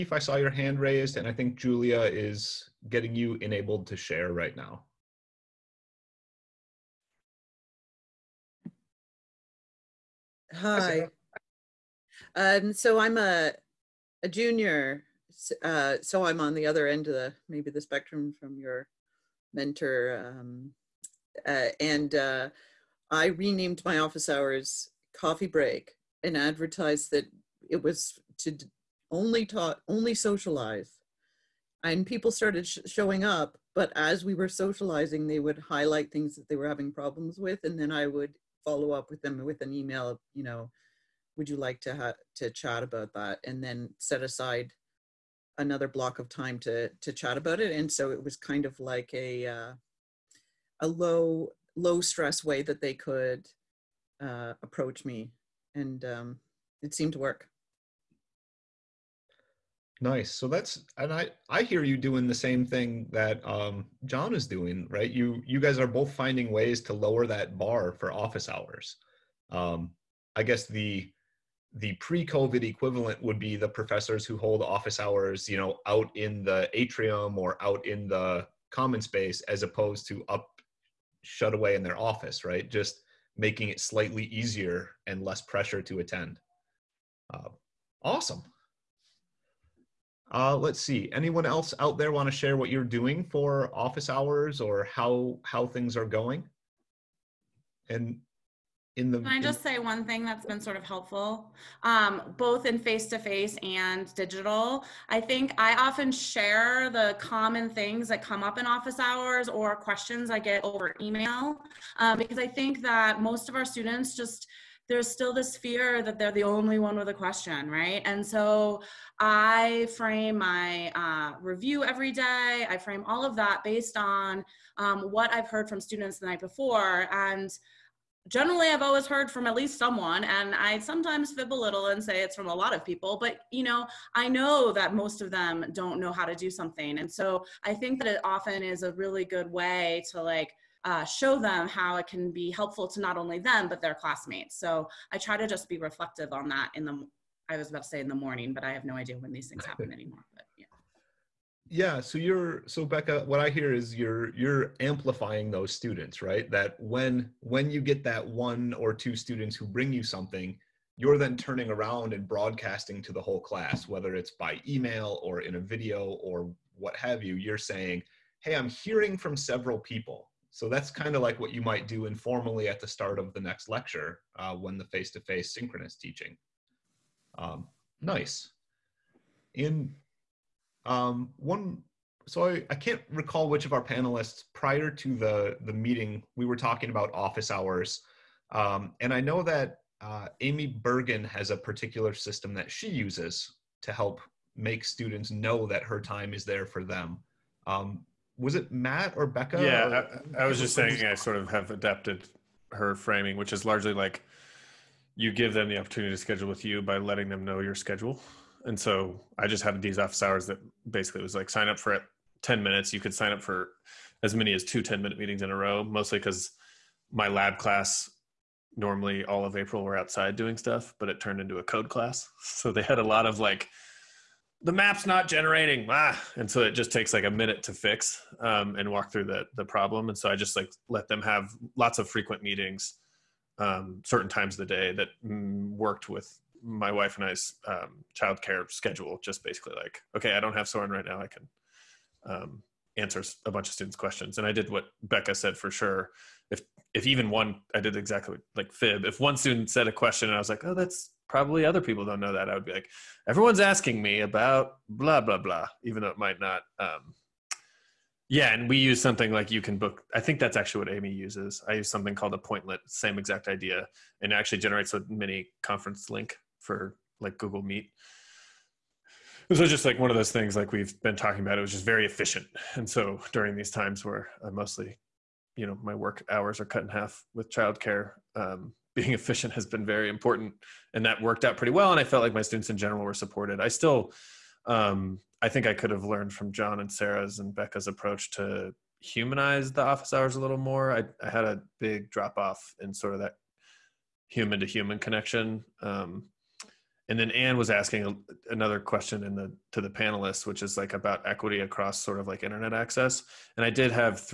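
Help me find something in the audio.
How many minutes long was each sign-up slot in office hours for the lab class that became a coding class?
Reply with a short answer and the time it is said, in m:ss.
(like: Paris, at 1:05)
10, at 3:32.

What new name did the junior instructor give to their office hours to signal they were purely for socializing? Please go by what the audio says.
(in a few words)
coffee break.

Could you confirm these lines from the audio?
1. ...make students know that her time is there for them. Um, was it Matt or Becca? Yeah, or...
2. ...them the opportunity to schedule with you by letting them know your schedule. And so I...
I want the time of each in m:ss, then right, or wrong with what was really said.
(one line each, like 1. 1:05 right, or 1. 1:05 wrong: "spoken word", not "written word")
1. 3:14 right
2. 3:25 right.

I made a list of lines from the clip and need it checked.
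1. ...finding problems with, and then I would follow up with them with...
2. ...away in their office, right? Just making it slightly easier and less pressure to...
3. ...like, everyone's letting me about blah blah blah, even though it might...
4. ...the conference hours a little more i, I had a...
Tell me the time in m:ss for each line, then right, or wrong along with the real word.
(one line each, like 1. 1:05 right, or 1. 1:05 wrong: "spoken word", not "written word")
1. 0:36 wrong: "having", not "finding"
2. 1:21 right
3. 4:12 wrong: "asking", not "letting"
4. 4:49 wrong: "office", not "conference".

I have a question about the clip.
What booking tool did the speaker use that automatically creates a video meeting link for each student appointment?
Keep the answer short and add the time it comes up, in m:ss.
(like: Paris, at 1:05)
Appointlet, at 4:22.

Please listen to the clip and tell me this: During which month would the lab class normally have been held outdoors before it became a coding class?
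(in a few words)
April.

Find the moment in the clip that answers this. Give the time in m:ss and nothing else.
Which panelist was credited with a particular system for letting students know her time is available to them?
3:10.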